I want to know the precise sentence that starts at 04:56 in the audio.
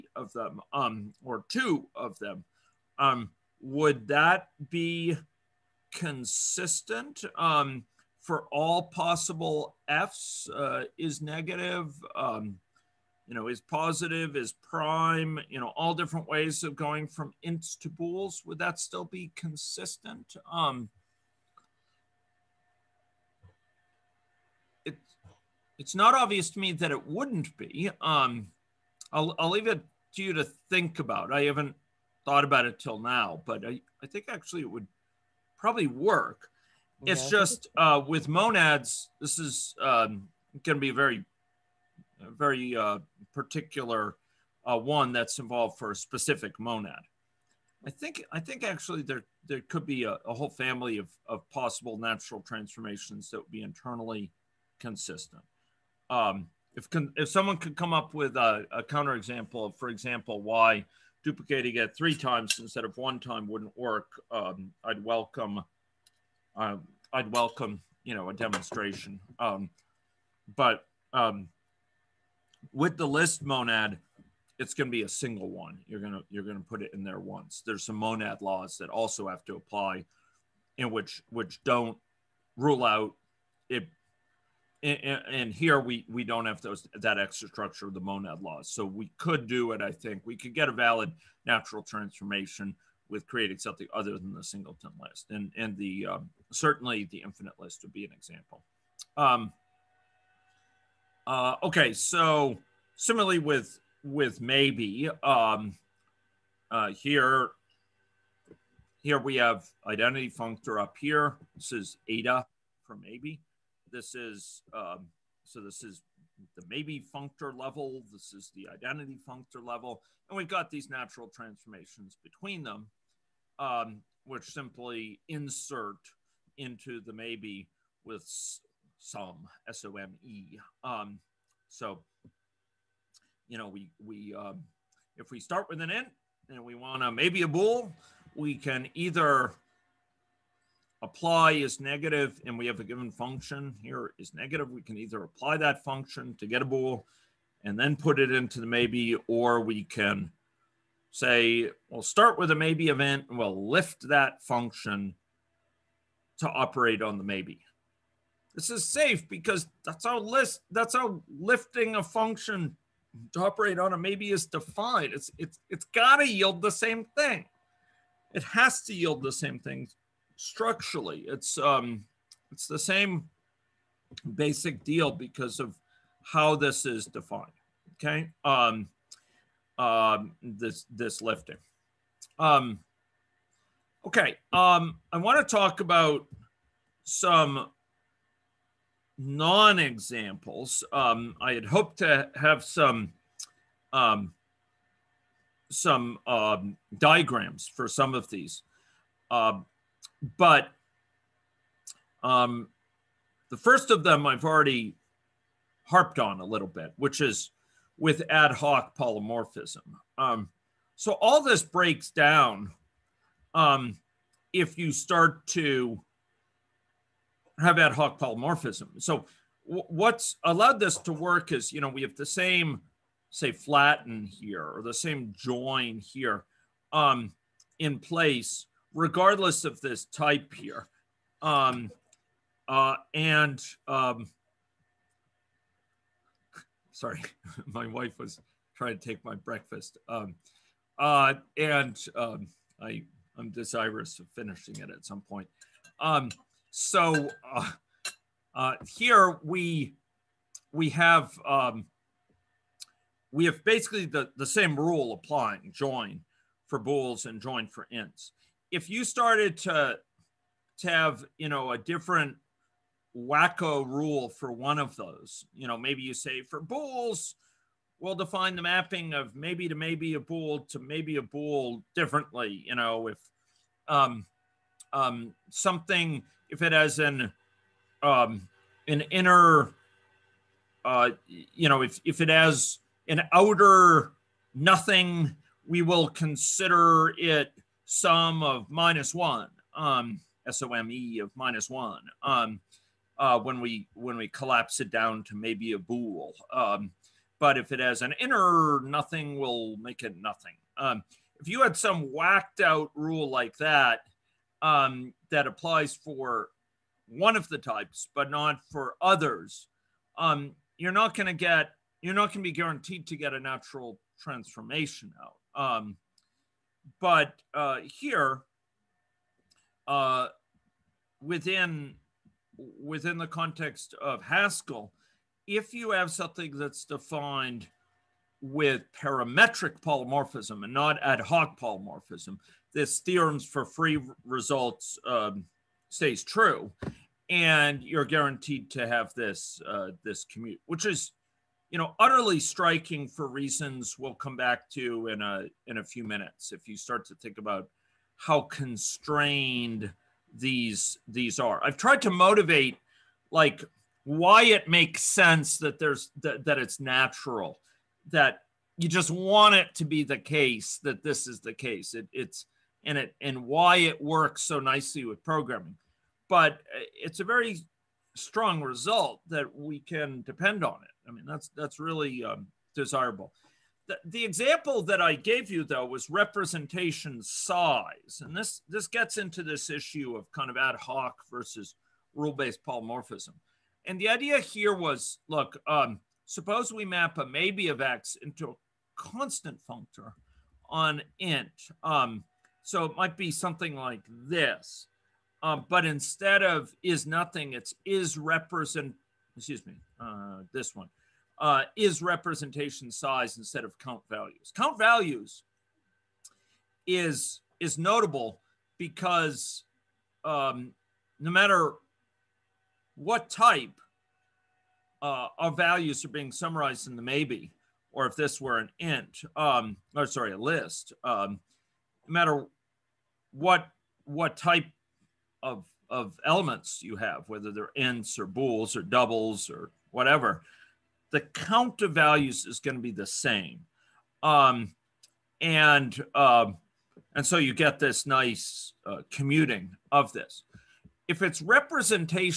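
Um, but if it has an inner nothing, we'll make it nothing.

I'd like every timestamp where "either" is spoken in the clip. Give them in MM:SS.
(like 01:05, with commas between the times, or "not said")
02:18, 02:24.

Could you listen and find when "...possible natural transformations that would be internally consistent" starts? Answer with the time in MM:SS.
00:51.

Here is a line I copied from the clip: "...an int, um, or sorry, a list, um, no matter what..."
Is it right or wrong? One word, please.
right.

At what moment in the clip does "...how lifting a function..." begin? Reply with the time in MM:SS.
02:40.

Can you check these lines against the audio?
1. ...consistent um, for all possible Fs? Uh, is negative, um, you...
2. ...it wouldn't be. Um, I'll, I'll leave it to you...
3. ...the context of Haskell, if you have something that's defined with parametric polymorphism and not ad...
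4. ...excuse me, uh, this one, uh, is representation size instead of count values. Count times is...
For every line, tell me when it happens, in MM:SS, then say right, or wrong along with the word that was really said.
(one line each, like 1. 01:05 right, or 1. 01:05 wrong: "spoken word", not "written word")
1. 00:05 right
2. 00:26 right
3. 05:23 right
4. 06:39 wrong: "values", not "times".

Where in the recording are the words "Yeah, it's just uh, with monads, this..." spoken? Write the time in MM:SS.
00:37.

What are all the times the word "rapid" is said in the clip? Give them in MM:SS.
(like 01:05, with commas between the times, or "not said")
not said.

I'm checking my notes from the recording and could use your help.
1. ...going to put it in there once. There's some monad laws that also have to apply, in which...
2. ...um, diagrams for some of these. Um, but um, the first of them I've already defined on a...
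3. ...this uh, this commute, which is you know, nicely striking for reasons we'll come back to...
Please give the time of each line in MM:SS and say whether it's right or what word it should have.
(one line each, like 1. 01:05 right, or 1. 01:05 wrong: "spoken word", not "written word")
1. 01:16 right
2. 03:16 wrong: "harped", not "defined"
3. 05:39 wrong: "utterly", not "nicely".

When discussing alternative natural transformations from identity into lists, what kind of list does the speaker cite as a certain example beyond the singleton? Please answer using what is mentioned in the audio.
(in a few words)
the infinite list.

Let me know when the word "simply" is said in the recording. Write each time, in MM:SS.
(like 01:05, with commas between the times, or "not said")
02:04.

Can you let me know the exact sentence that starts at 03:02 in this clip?
Um, okay, um, I want to talk about some non-examples.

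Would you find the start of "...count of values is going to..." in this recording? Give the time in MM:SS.
07:11.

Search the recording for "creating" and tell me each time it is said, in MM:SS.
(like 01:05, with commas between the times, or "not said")
01:33.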